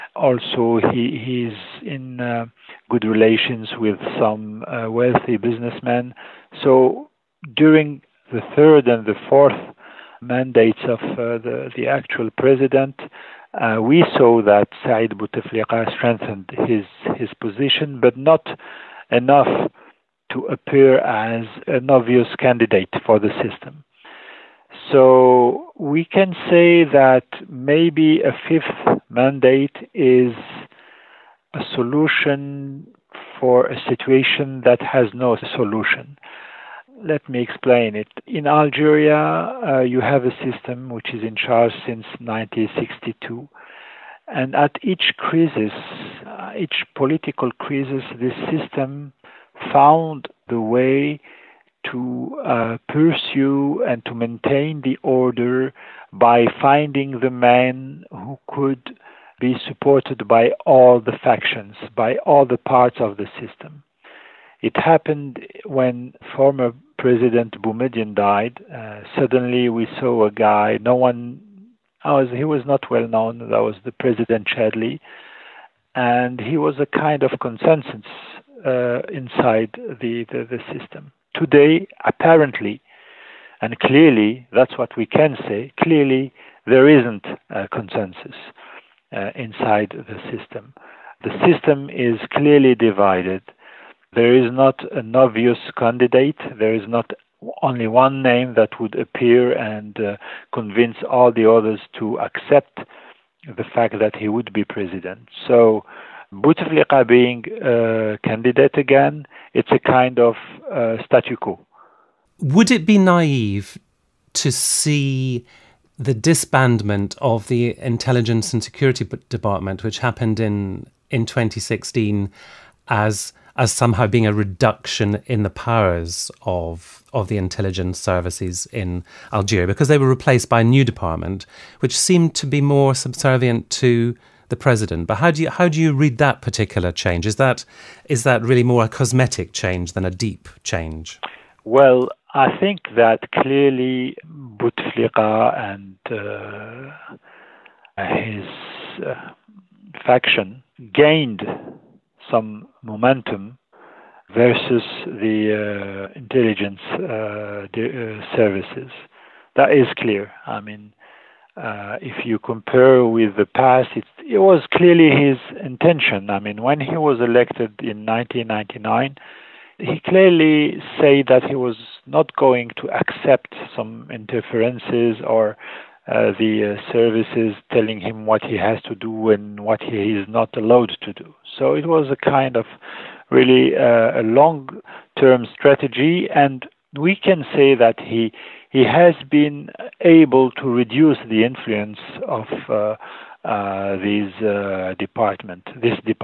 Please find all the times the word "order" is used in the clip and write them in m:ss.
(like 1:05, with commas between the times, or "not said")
0:55.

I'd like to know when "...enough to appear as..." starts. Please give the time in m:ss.
0:19.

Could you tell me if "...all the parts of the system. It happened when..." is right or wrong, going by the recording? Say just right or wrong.
right.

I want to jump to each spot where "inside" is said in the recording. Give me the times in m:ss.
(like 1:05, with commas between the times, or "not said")
1:19, 1:29.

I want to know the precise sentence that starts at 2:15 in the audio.
But how do you how do you read that particular change?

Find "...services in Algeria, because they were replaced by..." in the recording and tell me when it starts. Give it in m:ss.
2:07.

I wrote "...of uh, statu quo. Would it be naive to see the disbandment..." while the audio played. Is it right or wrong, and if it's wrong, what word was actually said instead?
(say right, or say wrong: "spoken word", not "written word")
right.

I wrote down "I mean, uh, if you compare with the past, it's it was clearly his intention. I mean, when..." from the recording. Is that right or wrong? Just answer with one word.
right.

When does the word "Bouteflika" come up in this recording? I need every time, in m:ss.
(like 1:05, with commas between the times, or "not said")
0:15, 1:46, 2:24.